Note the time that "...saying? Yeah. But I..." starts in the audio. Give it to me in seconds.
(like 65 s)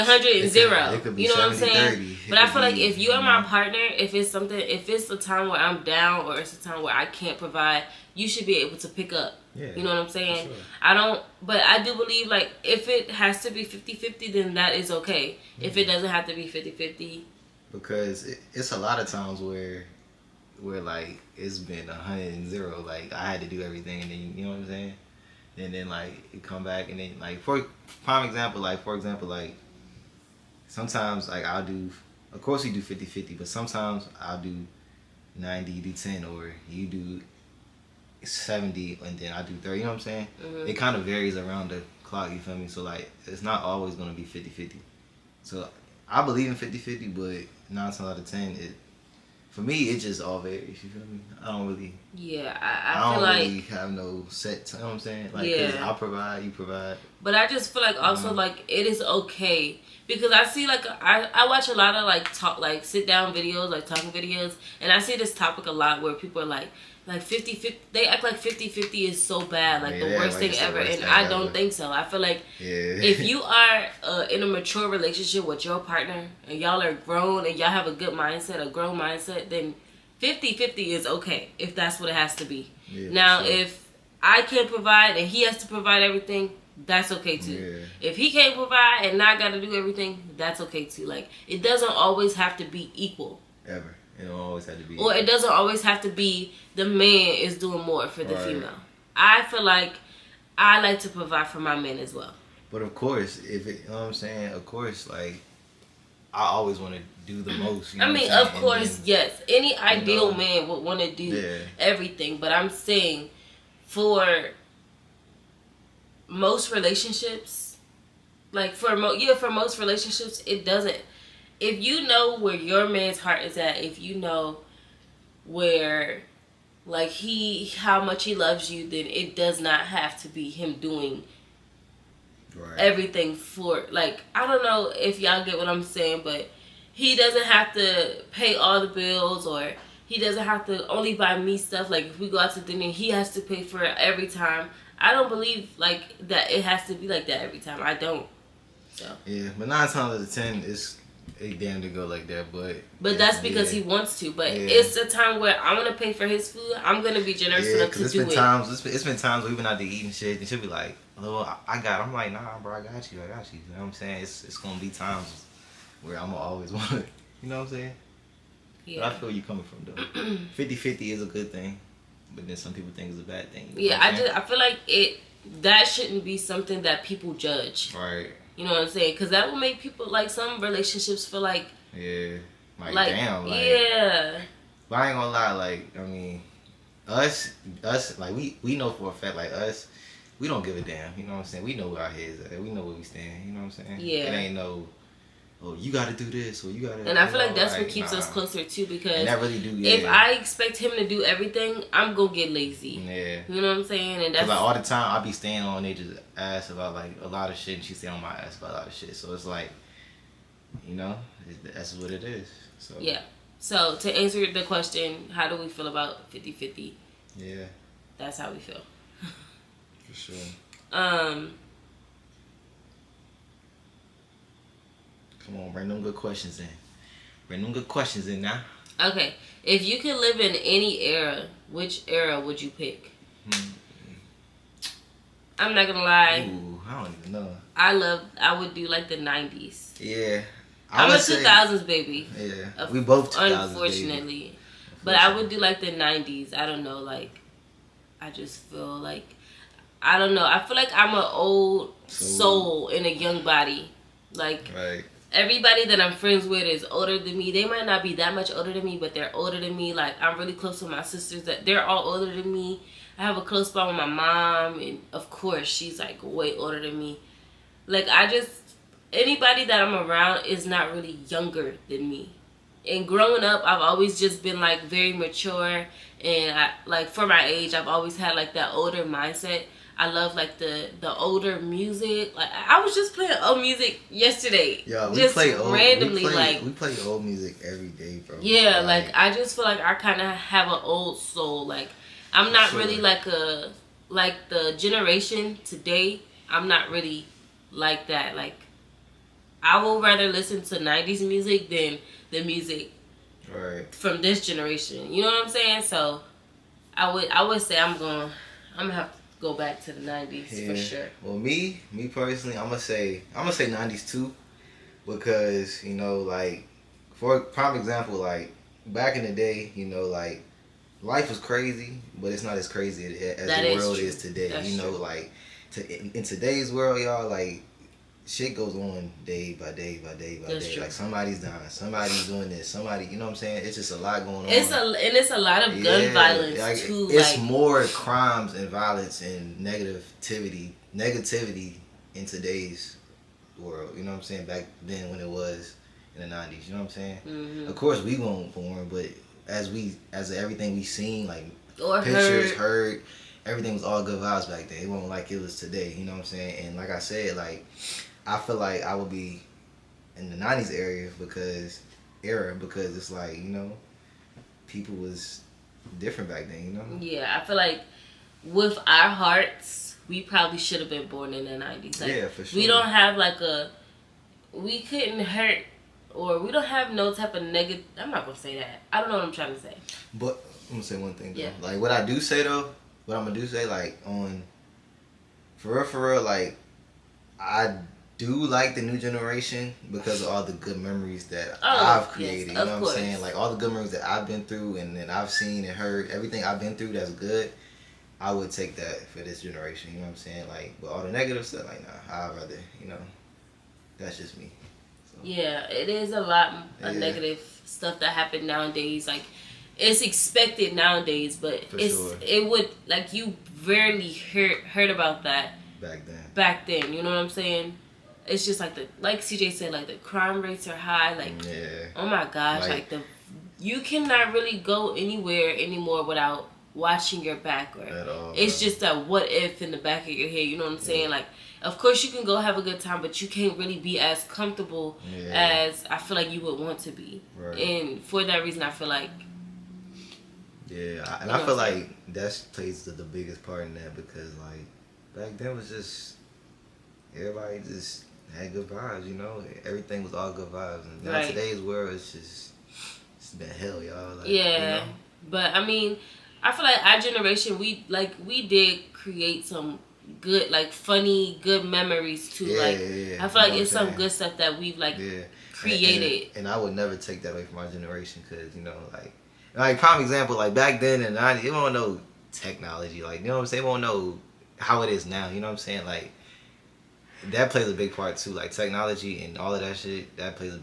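167 s.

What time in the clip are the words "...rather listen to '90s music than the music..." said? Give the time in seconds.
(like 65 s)
300 s.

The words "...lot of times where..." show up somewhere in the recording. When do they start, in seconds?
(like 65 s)
18 s.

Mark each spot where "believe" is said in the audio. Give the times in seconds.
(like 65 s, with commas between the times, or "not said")
11 s, 46 s, 145 s.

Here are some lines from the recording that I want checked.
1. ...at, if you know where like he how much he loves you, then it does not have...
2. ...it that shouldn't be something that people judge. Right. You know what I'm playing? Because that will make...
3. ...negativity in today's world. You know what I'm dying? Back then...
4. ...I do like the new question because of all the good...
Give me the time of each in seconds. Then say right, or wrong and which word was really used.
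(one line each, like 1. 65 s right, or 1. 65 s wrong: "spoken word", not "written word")
1. 123 s right
2. 174 s wrong: "saying", not "playing"
3. 340 s wrong: "saying", not "dying"
4. 387 s wrong: "generation", not "question".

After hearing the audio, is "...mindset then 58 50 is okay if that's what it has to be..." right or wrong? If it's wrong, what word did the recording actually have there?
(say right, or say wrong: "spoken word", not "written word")
wrong: "50", not "58".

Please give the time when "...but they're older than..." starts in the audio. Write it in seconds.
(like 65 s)
258 s.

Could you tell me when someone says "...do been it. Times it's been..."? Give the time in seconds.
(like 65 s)
158 s.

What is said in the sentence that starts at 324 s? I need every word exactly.
like to, in, in, today's world, y'all, like shit goes on day by day by day by That's day.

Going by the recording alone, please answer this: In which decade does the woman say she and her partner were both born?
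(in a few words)
2000s.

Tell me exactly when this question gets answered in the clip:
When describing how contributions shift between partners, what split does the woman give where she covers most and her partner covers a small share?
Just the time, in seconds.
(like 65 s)
34 s.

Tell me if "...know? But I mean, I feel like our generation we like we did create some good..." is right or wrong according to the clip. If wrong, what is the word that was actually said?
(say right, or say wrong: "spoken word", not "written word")
right.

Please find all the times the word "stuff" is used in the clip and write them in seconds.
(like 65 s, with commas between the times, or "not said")
141 s, 401 s, 407 s, 464 s.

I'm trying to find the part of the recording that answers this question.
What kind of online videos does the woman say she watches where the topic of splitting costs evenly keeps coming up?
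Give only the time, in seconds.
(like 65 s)
62 s.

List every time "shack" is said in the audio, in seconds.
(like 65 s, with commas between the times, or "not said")
not said.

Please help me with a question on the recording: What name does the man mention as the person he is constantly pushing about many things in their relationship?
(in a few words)
Nasia.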